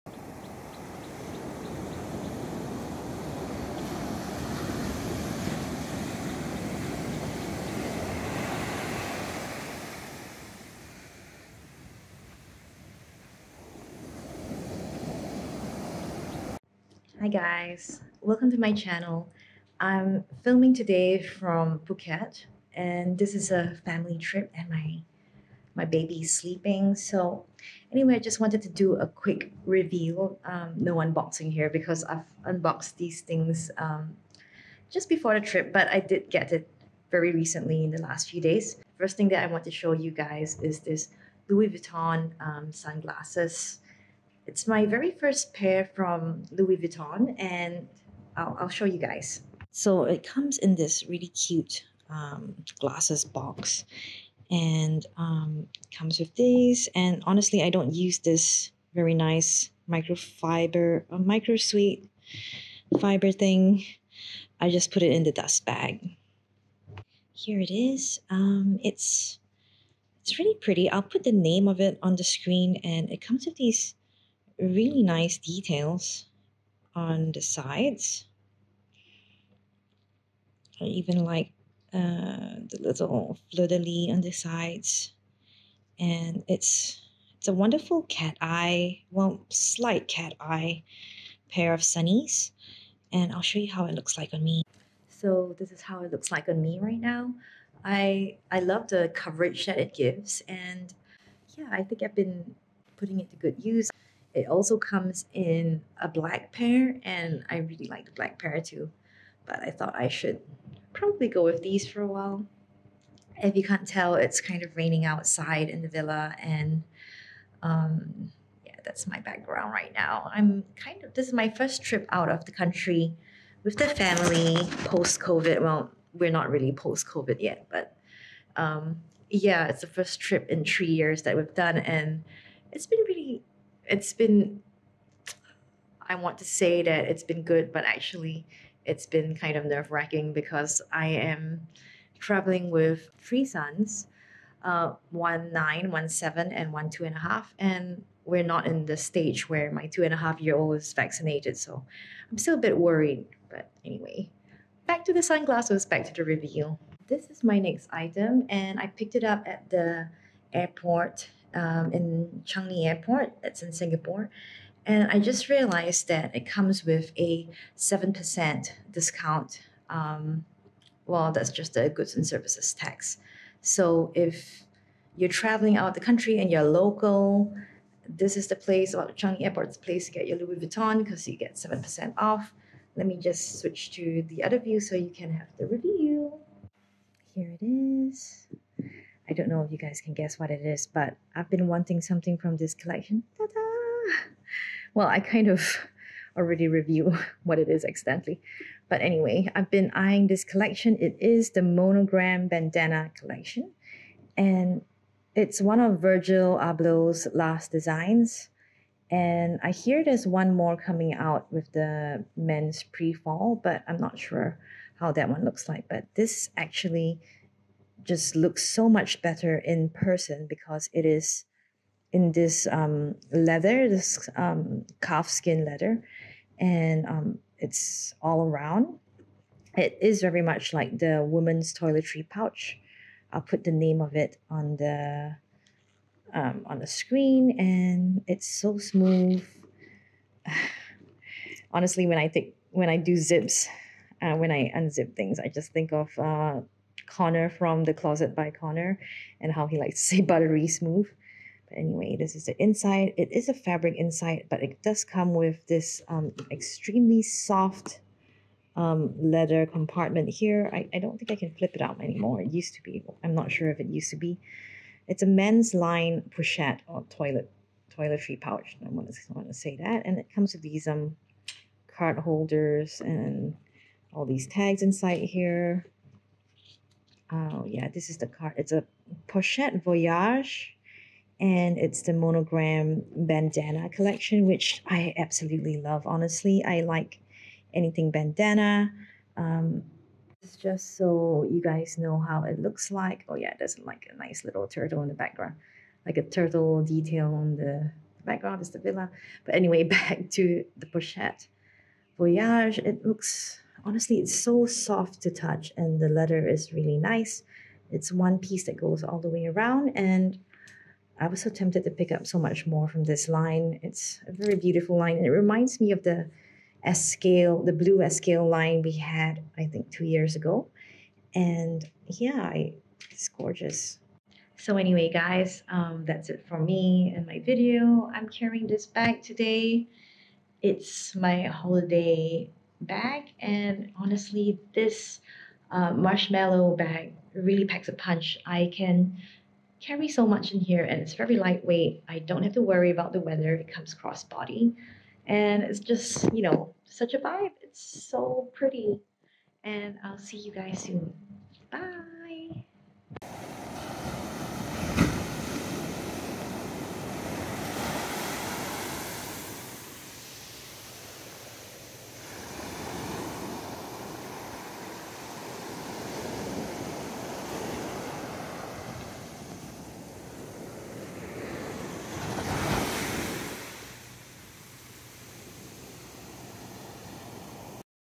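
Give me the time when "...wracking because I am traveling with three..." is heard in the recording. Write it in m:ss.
2:19.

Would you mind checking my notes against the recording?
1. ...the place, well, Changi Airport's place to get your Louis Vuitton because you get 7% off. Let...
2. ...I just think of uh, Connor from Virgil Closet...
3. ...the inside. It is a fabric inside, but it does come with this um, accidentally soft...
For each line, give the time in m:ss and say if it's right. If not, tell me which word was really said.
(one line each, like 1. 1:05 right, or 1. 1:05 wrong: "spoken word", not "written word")
1. 2:58 right
2. 4:05 wrong: "The", not "Virgil"
3. 4:12 wrong: "extremely", not "accidentally".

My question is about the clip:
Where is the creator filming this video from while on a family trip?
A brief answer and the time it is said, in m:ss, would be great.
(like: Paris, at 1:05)
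Phuket, at 0:21.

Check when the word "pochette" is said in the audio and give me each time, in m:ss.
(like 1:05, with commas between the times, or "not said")
4:26, 4:39, 5:00.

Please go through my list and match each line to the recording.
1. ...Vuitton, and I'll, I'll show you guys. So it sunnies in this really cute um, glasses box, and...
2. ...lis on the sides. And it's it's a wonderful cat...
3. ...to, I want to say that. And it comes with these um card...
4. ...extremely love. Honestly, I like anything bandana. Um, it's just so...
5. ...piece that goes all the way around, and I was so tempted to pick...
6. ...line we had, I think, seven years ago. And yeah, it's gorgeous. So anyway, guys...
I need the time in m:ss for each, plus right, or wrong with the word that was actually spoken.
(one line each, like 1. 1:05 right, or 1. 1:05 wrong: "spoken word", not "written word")
1. 0:46 wrong: "comes", not "sunnies"
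2. 1:23 right
3. 4:29 right
4. 4:45 wrong: "absolutely", not "extremely"
5. 5:08 right
6. 5:18 wrong: "two", not "seven".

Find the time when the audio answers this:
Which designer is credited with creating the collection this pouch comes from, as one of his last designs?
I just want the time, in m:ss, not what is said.
3:26.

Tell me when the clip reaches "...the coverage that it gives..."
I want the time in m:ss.
1:38.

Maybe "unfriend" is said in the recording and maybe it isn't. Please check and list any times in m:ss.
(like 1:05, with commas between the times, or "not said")
not said.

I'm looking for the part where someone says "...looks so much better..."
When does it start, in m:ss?
3:38.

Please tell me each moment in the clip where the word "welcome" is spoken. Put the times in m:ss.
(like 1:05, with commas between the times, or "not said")
0:18.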